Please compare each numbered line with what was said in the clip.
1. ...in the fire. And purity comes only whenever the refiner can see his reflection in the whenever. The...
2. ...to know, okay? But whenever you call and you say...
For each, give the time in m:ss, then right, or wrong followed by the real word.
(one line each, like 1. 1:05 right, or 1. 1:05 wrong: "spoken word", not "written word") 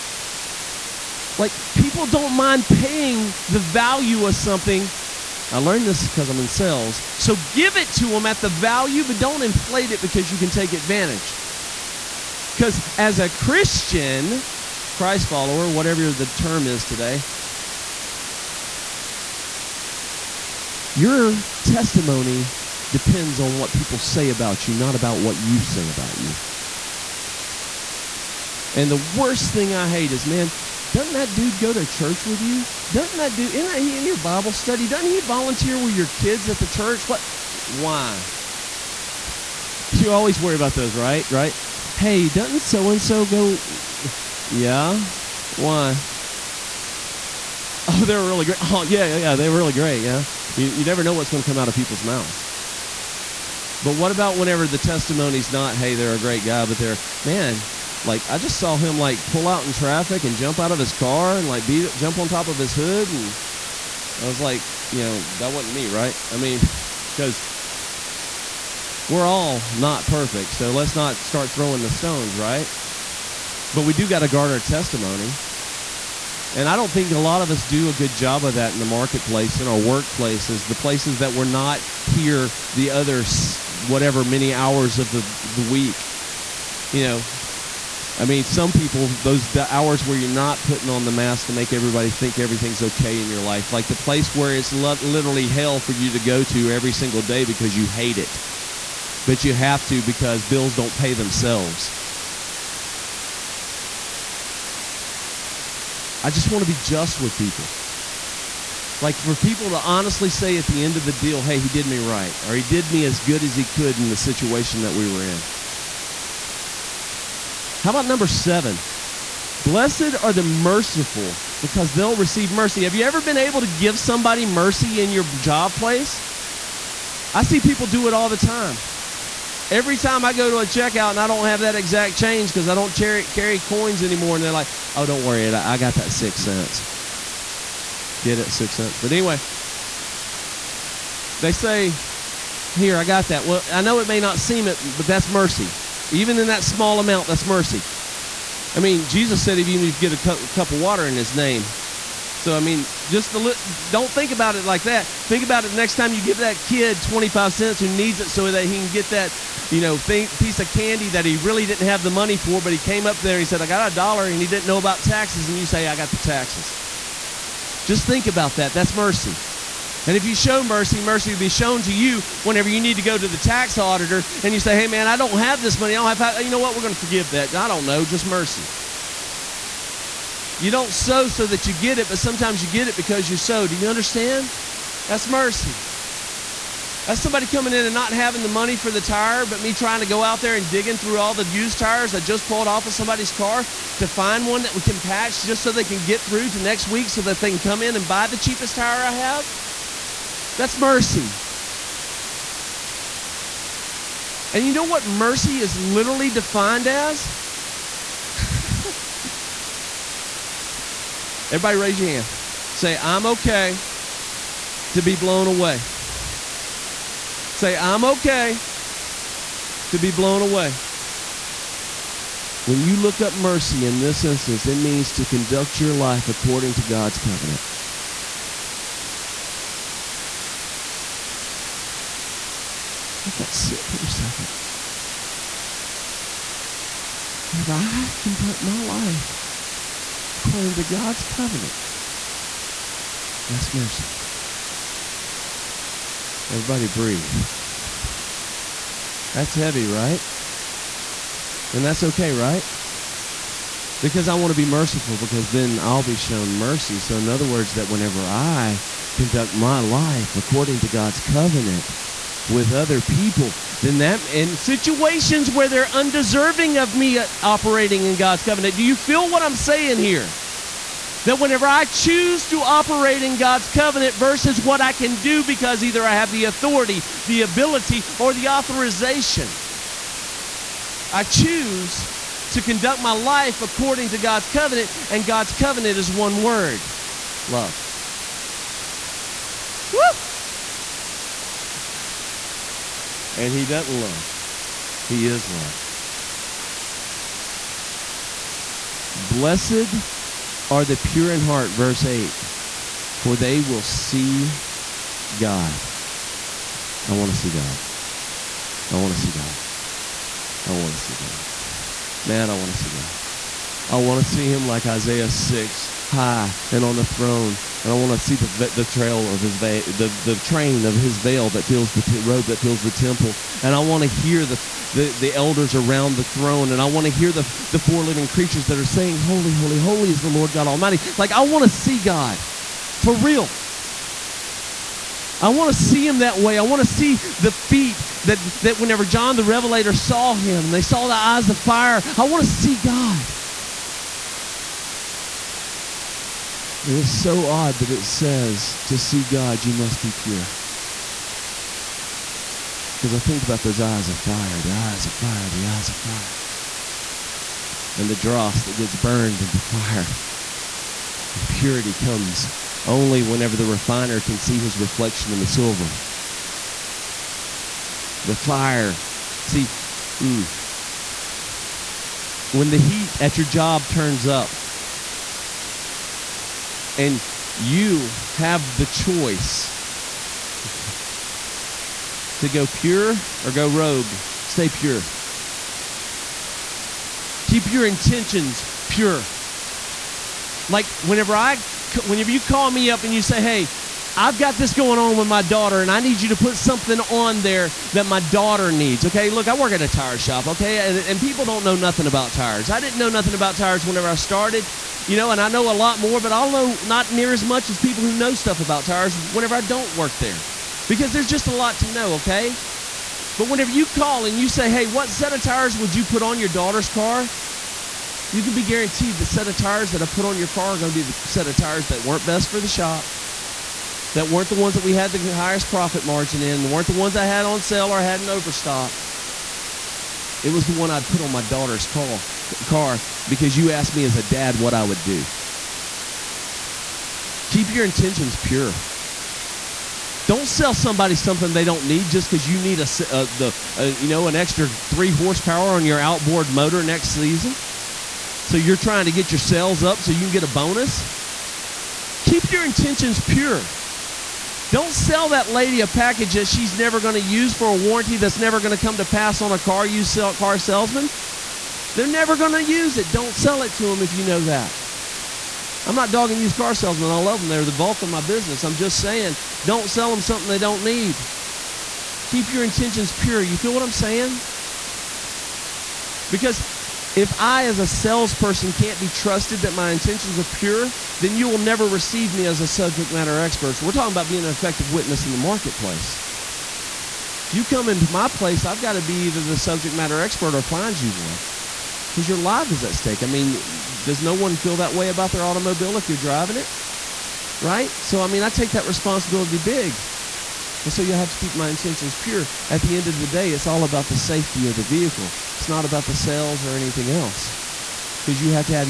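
1. 5:59 wrong: "silver", not "whenever"
2. 6:51 right.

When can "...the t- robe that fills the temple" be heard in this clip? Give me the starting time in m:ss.
5:21.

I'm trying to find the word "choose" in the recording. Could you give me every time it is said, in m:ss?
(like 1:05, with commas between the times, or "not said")
4:31, 4:41.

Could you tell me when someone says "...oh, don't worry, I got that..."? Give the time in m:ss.
2:14.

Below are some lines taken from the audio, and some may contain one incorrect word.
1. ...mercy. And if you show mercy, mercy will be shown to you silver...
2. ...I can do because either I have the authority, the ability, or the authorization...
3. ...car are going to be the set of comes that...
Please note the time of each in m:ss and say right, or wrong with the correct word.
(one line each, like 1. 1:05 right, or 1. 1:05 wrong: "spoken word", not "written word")
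1. 2:48 wrong: "whenever", not "silver"
2. 4:34 right
3. 7:00 wrong: "tires", not "comes".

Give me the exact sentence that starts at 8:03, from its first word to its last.
So we're talking about being an effective witness in the marketplace.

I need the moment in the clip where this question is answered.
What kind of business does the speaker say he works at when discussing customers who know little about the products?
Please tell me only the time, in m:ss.
6:39.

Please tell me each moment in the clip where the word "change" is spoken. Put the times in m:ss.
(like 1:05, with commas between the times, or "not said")
2:12.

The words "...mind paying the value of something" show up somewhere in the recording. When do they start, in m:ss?
0:02.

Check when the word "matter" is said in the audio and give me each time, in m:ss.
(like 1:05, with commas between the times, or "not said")
8:03, 8:09.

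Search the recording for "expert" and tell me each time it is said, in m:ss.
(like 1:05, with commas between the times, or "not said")
8:03, 8:10.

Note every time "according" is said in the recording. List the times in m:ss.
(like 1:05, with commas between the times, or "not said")
3:46, 4:00, 4:20, 4:43.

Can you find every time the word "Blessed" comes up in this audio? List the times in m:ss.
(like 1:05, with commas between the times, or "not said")
1:59, 4:59.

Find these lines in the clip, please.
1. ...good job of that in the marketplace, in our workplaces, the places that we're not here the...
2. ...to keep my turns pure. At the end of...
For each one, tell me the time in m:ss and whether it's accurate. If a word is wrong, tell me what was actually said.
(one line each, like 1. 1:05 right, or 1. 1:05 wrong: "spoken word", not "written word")
1. 1:17 right
2. 8:21 wrong: "intentions", not "turns".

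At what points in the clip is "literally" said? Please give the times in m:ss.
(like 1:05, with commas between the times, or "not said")
1:34, 3:25.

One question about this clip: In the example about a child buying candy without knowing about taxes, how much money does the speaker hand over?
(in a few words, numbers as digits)
25 cents.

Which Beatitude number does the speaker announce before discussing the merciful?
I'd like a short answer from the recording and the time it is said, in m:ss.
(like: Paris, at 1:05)
7, at 1:58.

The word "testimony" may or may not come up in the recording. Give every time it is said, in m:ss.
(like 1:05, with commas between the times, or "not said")
0:21, 0:54, 1:14.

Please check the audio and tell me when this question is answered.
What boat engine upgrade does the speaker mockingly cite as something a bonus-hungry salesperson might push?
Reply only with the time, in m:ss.
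7:24.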